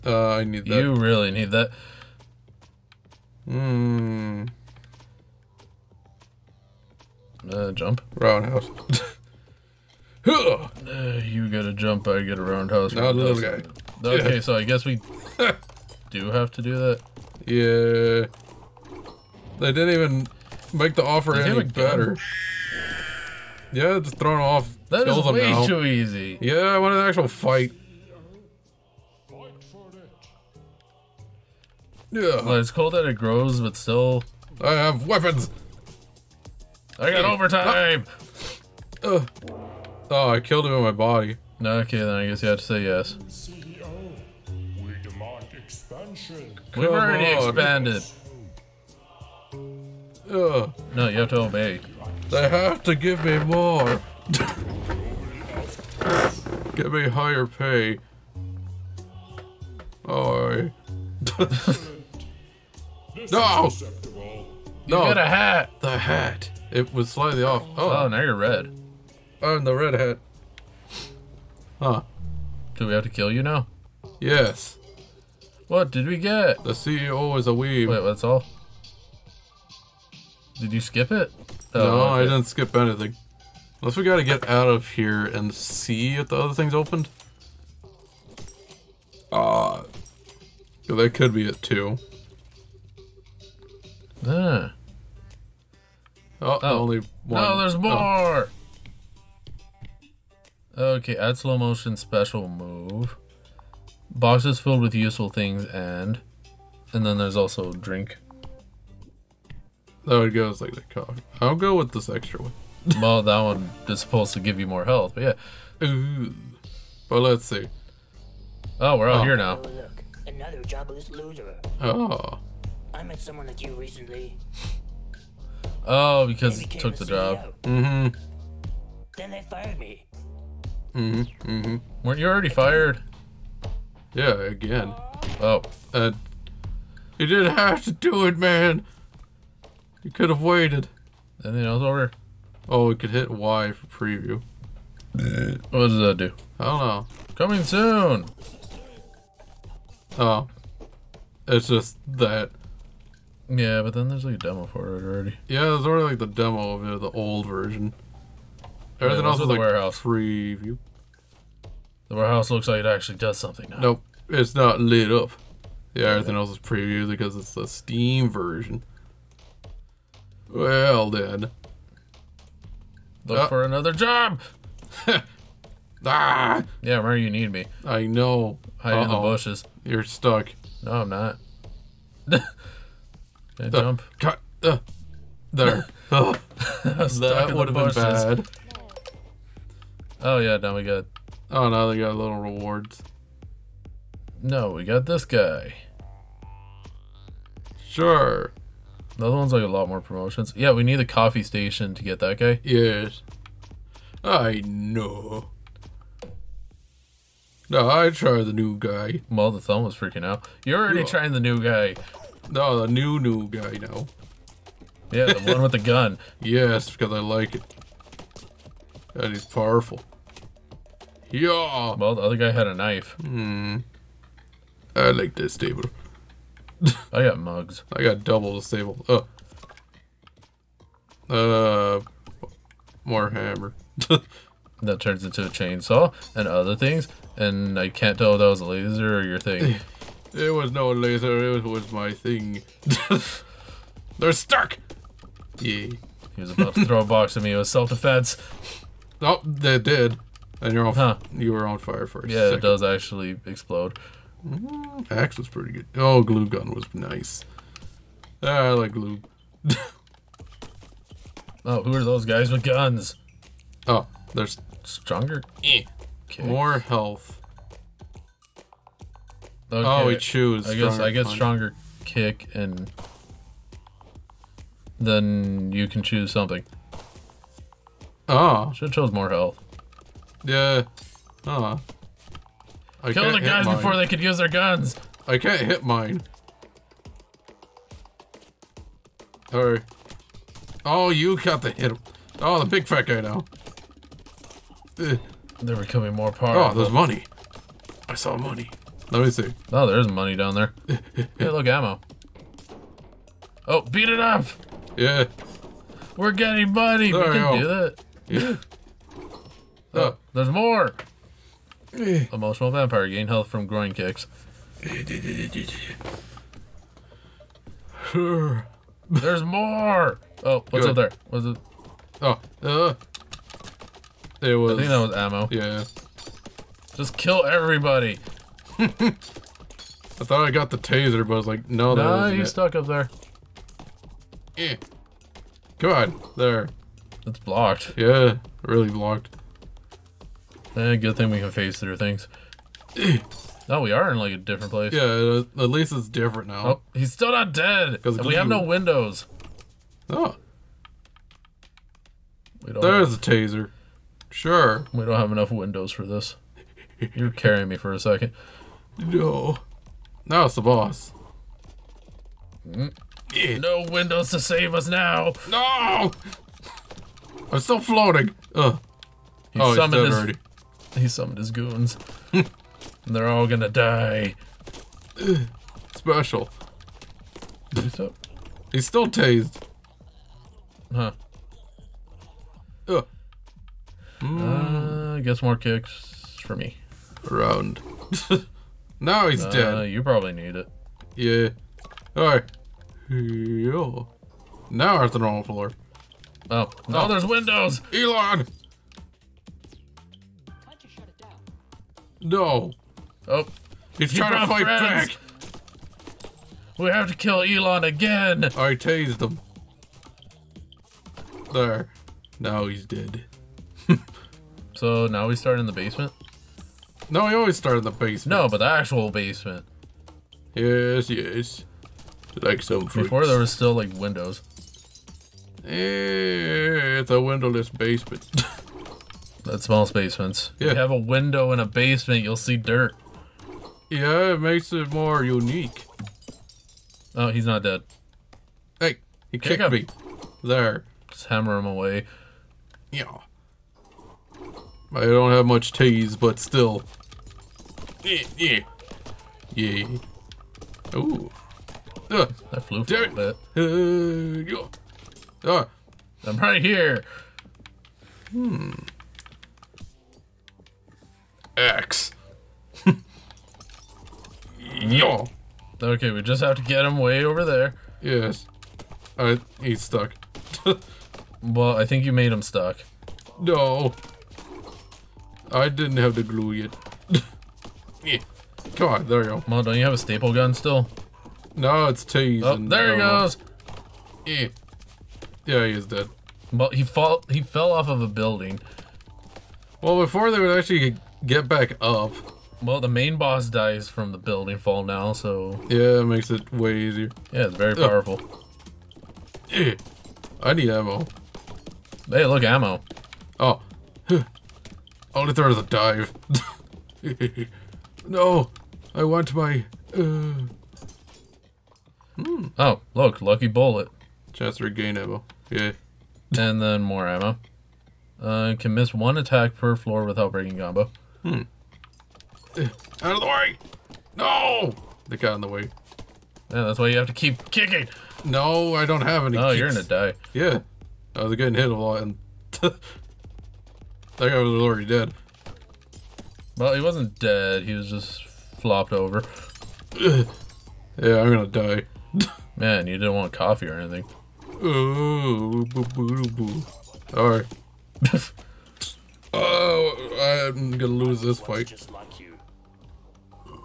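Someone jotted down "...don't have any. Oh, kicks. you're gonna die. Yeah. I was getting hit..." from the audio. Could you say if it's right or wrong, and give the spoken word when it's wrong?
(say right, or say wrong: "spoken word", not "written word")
right.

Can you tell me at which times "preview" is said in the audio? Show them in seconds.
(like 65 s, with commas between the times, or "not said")
143 s, 166 s.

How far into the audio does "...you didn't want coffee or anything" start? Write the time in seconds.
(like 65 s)
542 s.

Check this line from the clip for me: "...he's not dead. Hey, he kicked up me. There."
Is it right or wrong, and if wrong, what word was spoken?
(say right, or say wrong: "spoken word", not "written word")
right.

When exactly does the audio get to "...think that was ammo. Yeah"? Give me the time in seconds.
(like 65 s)
324 s.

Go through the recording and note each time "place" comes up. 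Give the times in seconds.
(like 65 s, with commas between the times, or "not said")
344 s.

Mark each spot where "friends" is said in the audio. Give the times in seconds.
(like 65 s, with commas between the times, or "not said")
404 s.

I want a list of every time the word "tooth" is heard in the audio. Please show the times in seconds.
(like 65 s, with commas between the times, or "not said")
not said.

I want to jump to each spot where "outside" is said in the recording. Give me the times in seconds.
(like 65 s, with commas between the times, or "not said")
not said.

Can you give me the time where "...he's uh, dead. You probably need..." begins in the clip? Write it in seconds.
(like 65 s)
389 s.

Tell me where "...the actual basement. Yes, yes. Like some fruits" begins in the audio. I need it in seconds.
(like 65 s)
418 s.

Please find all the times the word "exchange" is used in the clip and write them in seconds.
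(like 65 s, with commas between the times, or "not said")
not said.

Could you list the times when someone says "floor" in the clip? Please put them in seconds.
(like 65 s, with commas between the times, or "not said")
395 s, 519 s.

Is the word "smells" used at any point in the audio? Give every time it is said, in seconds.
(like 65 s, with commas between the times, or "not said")
429 s.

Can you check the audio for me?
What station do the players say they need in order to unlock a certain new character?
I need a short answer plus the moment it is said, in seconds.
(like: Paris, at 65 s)
Coffee station, at 201 s.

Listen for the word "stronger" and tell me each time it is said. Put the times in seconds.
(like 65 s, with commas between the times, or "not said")
264 s, 271 s.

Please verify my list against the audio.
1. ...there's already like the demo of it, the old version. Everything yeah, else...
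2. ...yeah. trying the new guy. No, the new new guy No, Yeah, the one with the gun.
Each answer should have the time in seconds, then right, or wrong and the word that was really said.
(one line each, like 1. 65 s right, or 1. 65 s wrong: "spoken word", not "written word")
1. 155 s right
2. 211 s right.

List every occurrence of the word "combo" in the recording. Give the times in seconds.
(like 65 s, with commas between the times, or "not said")
520 s.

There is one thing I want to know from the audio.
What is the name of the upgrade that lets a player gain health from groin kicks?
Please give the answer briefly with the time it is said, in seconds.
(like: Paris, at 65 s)
Emotional vampire, at 311 s.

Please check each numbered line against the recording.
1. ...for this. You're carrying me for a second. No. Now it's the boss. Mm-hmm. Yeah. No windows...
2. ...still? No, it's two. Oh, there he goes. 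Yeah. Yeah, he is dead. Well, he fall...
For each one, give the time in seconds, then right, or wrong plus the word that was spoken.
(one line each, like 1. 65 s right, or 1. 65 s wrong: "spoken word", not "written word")
1. 355 s right
2. 480 s right.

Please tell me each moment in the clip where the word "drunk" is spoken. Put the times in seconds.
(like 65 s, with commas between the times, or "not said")
not said.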